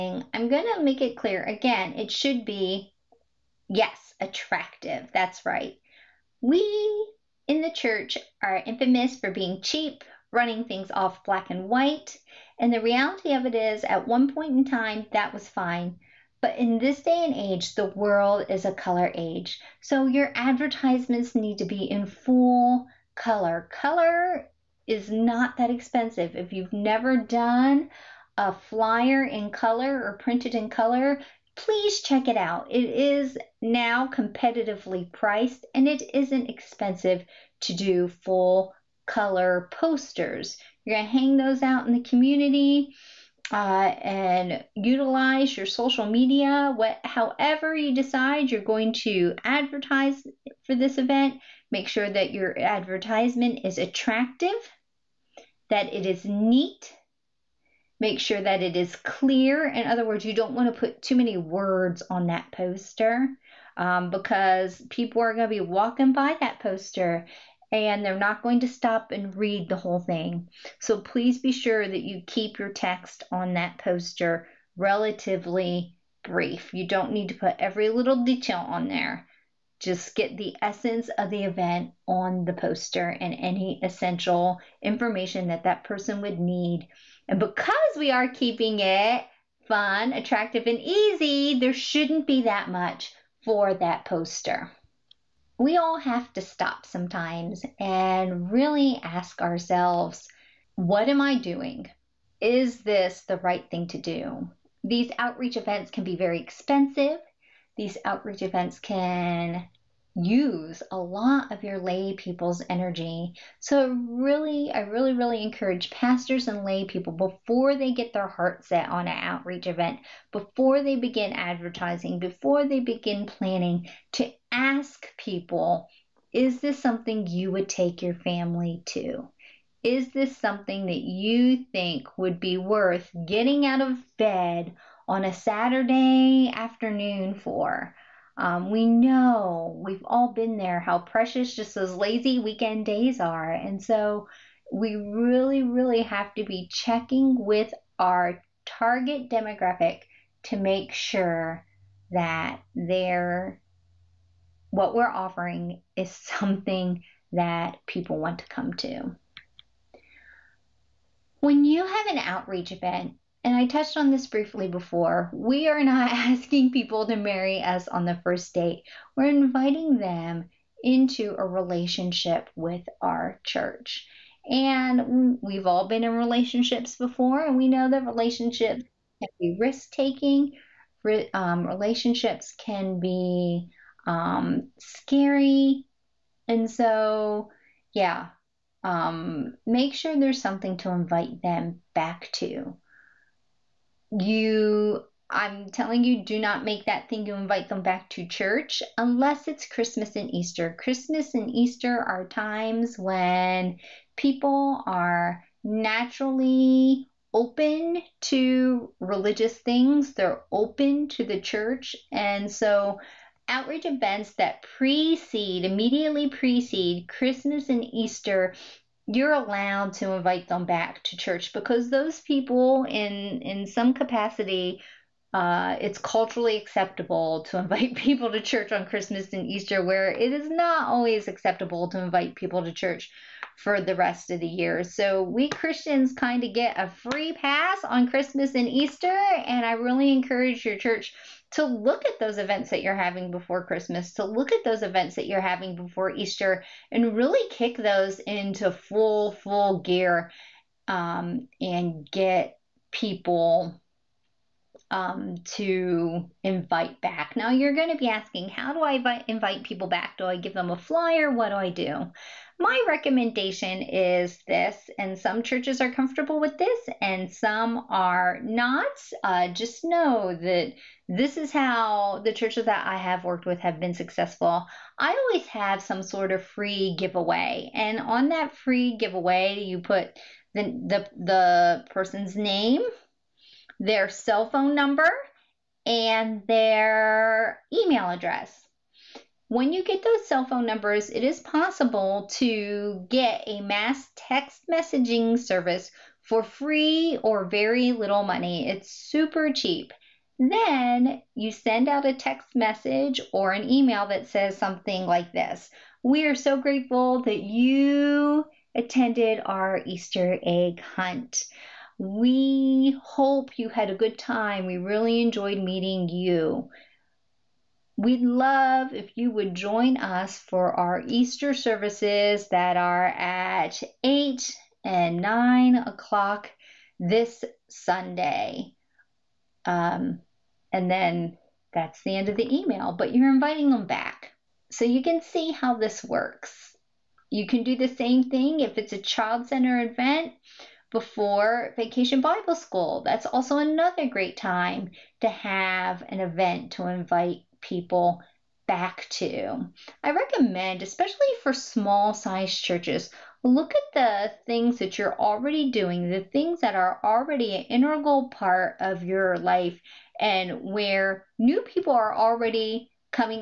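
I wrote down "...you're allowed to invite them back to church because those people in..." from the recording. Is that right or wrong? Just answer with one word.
right.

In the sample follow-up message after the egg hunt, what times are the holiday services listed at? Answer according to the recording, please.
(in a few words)
8 and 9 o'clock.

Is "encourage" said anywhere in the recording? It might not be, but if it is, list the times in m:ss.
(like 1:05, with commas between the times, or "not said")
1:55, 4:00.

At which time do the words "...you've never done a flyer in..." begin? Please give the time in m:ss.
0:26.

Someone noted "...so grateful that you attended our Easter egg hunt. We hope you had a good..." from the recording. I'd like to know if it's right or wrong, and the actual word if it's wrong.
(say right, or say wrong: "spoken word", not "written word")
right.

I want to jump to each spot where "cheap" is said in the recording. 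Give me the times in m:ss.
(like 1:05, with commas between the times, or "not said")
0:09, 4:59.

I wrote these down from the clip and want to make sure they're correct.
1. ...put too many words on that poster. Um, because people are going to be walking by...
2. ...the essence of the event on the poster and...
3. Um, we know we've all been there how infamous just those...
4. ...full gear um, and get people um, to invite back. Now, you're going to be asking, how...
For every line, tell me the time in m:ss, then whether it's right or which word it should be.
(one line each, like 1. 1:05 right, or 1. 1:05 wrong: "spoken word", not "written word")
1. 1:00 right
2. 1:20 right
3. 2:18 wrong: "precious", not "infamous"
4. 4:09 right.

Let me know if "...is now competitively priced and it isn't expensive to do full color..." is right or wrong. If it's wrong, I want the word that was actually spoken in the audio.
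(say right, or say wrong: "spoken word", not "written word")
right.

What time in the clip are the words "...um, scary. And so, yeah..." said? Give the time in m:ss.
3:04.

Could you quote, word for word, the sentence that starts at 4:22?
My recommendation is this, and some churches are comfortable with this and some are not.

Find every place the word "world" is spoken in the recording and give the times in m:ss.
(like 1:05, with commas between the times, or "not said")
0:17.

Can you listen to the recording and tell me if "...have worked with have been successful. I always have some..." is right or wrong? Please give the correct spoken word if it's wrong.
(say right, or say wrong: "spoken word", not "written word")
right.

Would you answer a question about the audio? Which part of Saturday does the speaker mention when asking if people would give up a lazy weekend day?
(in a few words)
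afternoon.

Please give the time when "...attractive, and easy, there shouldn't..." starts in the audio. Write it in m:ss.
1:30.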